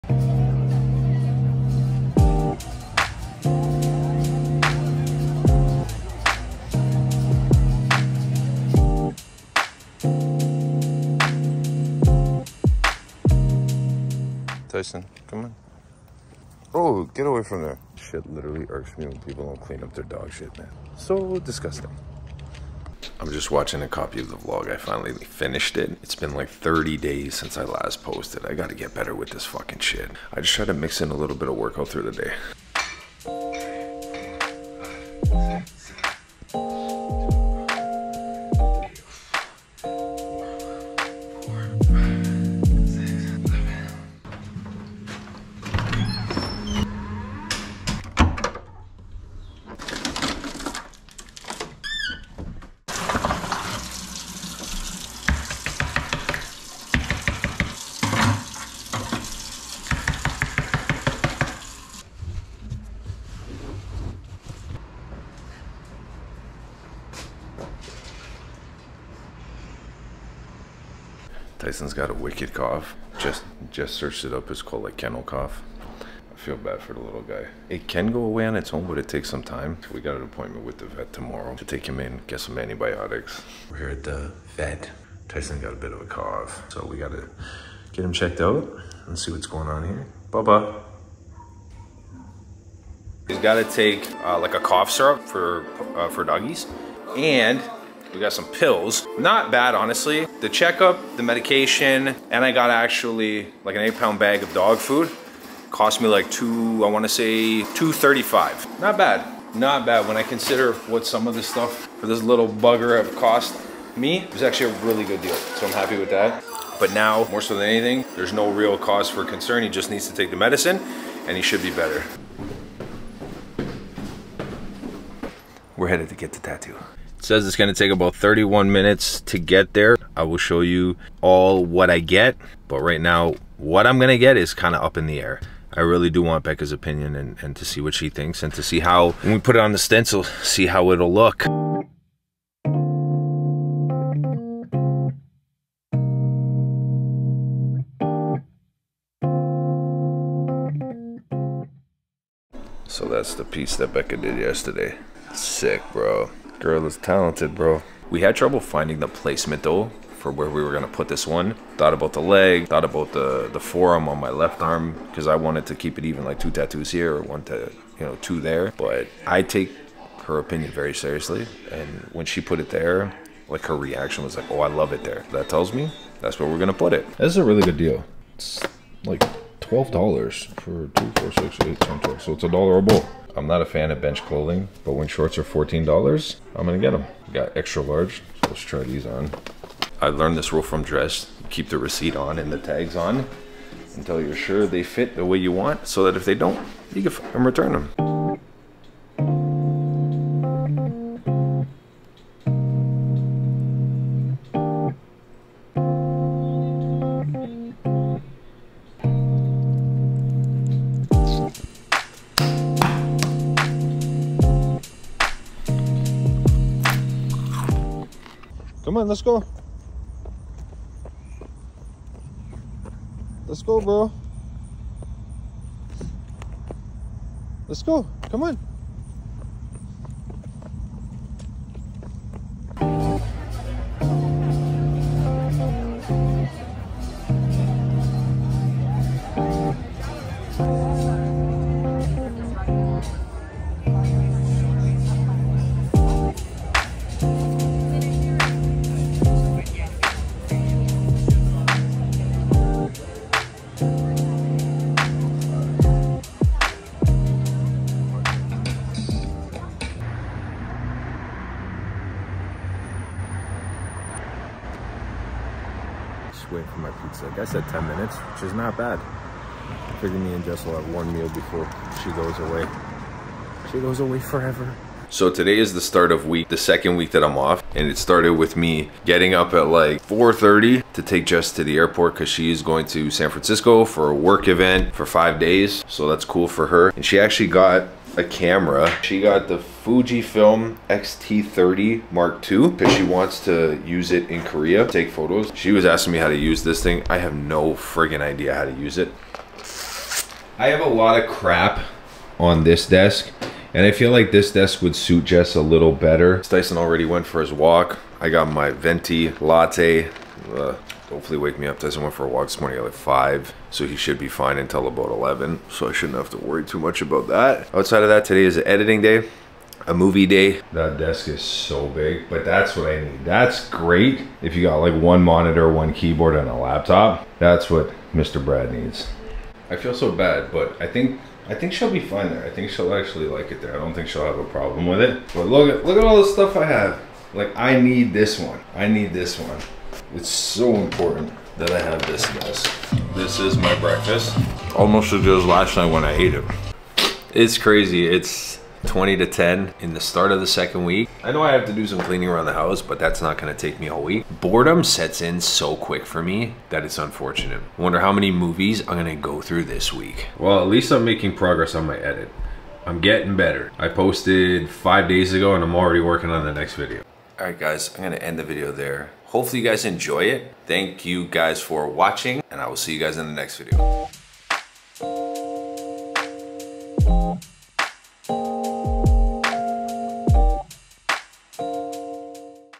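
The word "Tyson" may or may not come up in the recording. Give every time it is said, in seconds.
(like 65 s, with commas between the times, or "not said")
14 s, 71 s, 85 s, 306 s, 311 s.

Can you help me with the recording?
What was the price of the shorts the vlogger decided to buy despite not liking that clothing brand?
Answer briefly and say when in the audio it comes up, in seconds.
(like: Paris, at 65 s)
$14, at 185 s.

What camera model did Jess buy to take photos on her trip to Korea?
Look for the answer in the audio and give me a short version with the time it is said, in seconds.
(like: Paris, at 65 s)
Fujifilm X-T30 Mark II, at 289 s.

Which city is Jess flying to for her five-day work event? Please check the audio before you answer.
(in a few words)
San Francisco.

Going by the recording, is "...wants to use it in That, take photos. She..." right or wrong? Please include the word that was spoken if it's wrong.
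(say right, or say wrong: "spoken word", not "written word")
wrong: "Korea", not "That".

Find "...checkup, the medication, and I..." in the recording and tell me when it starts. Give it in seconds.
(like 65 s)
100 s.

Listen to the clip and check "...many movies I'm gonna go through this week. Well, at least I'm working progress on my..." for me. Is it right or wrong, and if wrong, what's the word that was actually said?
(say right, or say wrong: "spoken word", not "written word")
wrong: "making", not "working".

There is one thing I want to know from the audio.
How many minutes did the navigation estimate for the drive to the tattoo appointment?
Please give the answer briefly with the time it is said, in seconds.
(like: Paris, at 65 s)
31, at 128 s.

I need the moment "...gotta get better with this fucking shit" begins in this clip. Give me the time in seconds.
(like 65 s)
28 s.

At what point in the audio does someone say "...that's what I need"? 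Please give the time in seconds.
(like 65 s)
322 s.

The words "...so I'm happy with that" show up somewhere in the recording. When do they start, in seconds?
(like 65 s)
115 s.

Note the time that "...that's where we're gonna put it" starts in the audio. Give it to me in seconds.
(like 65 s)
176 s.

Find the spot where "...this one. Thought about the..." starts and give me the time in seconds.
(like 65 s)
161 s.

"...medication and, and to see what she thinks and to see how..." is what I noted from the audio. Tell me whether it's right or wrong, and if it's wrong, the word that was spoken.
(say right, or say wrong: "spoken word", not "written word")
wrong: "opinion", not "medication".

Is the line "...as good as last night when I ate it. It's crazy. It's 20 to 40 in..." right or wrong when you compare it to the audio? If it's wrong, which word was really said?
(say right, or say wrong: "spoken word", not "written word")
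wrong: "10", not "40".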